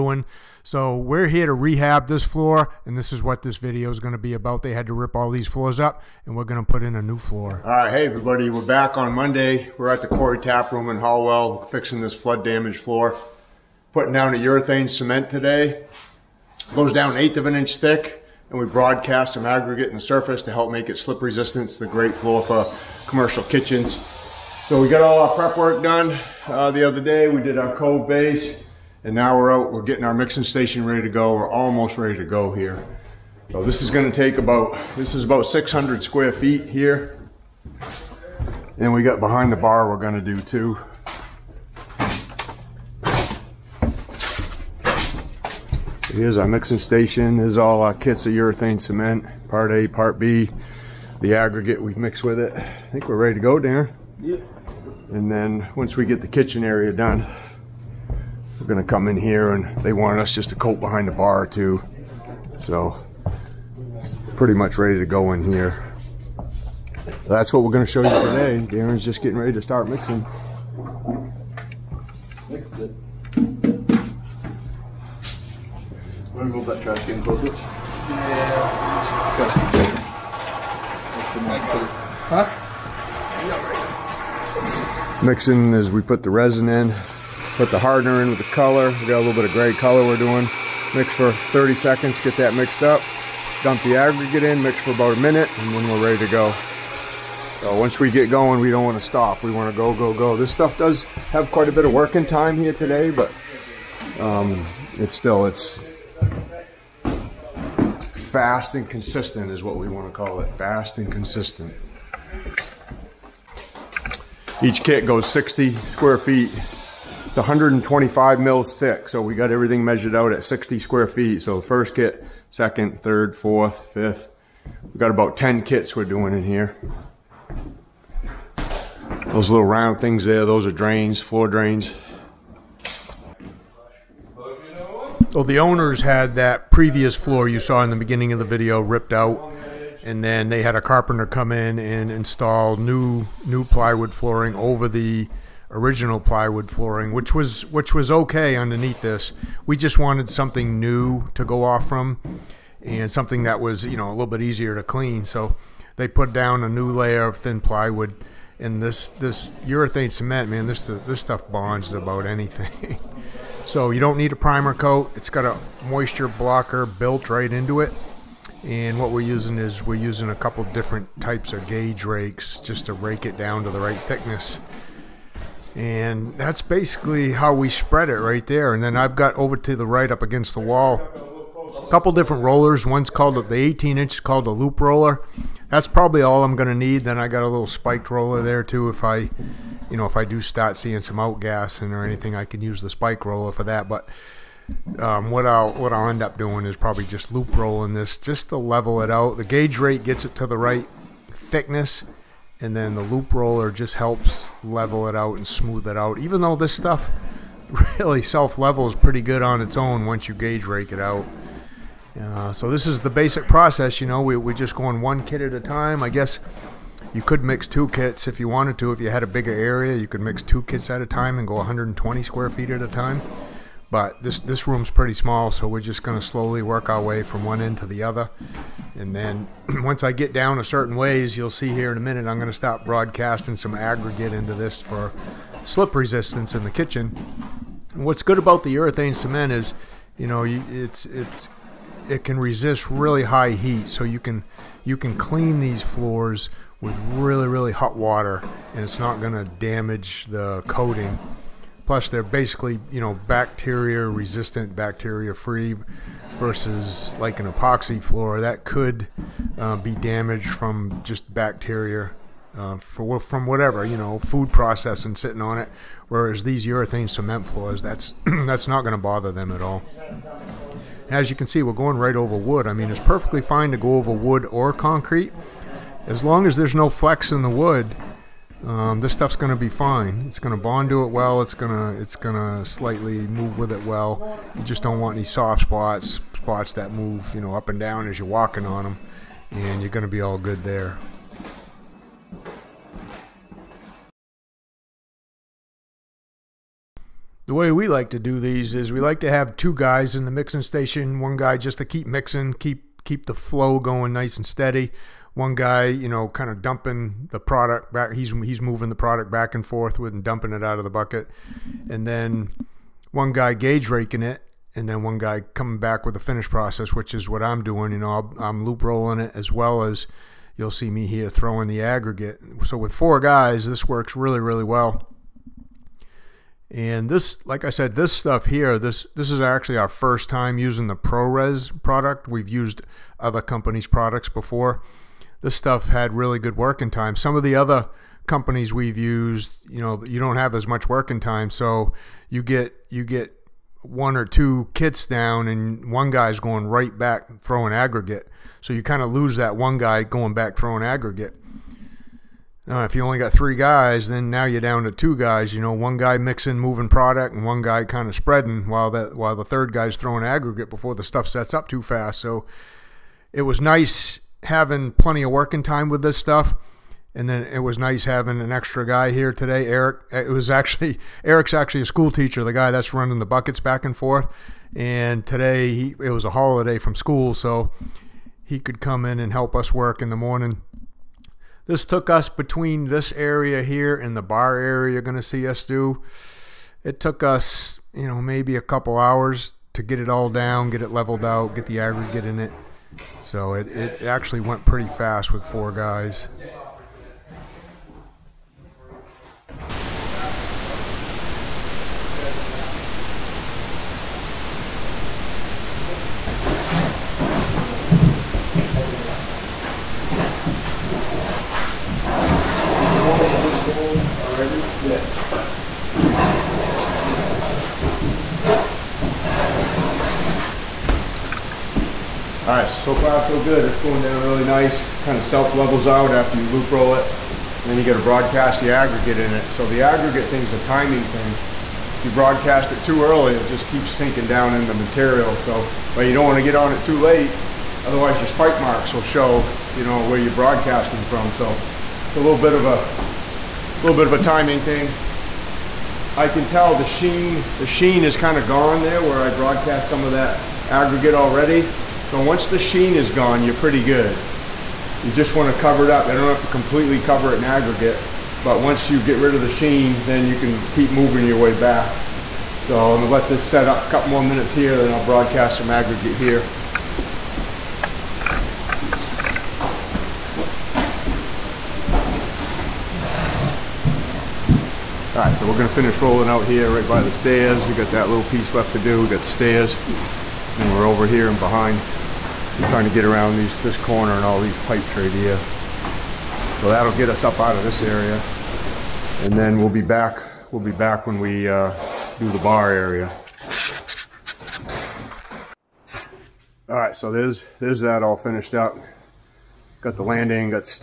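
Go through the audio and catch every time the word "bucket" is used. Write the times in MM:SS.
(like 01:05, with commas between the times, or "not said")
05:10, 06:13.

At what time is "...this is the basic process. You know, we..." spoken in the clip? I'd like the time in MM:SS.
03:32.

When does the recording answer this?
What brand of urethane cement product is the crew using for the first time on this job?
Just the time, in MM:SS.
05:30.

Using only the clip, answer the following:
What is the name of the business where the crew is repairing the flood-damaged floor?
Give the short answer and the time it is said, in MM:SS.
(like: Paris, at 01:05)
Quarry Tap Room, at 00:10.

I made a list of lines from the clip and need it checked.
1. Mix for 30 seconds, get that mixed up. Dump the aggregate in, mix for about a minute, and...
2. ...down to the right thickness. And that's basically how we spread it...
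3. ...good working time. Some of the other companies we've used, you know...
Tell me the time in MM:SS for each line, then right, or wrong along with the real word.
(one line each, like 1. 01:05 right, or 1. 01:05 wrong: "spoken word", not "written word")
1. 01:30 right
2. 02:53 right
3. 05:36 right.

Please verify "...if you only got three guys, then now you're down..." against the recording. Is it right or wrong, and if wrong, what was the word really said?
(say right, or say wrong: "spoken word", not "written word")
right.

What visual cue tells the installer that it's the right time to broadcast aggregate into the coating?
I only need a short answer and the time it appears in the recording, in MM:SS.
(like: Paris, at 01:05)
sheen is gone, at 07:27.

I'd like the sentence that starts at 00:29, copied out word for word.
We're getting our mixing station ready to go.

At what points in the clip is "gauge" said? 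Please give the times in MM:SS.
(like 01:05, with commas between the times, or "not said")
02:51, 03:19, 03:30, 05:13.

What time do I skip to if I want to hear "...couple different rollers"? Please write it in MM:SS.
03:01.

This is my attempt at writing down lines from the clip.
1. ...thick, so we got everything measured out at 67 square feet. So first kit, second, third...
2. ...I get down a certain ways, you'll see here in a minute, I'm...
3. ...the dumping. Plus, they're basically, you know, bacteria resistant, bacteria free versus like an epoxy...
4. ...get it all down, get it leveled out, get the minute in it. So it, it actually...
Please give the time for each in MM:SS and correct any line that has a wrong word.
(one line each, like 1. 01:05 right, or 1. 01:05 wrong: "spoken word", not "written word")
1. 01:58 wrong: "60", not "67"
2. 03:50 right
3. 04:10 wrong: "coating", not "dumping"
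4. 06:29 wrong: "aggregate", not "minute".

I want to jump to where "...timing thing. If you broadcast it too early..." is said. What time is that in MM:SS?
07:10.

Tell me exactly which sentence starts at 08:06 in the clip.
So that'll get us up out of this area.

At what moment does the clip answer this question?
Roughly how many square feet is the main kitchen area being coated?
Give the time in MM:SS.
00:35.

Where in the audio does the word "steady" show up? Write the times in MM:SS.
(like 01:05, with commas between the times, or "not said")
05:04.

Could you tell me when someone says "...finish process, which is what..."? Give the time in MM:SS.
05:16.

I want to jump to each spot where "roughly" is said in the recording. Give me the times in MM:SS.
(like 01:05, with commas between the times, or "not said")
not said.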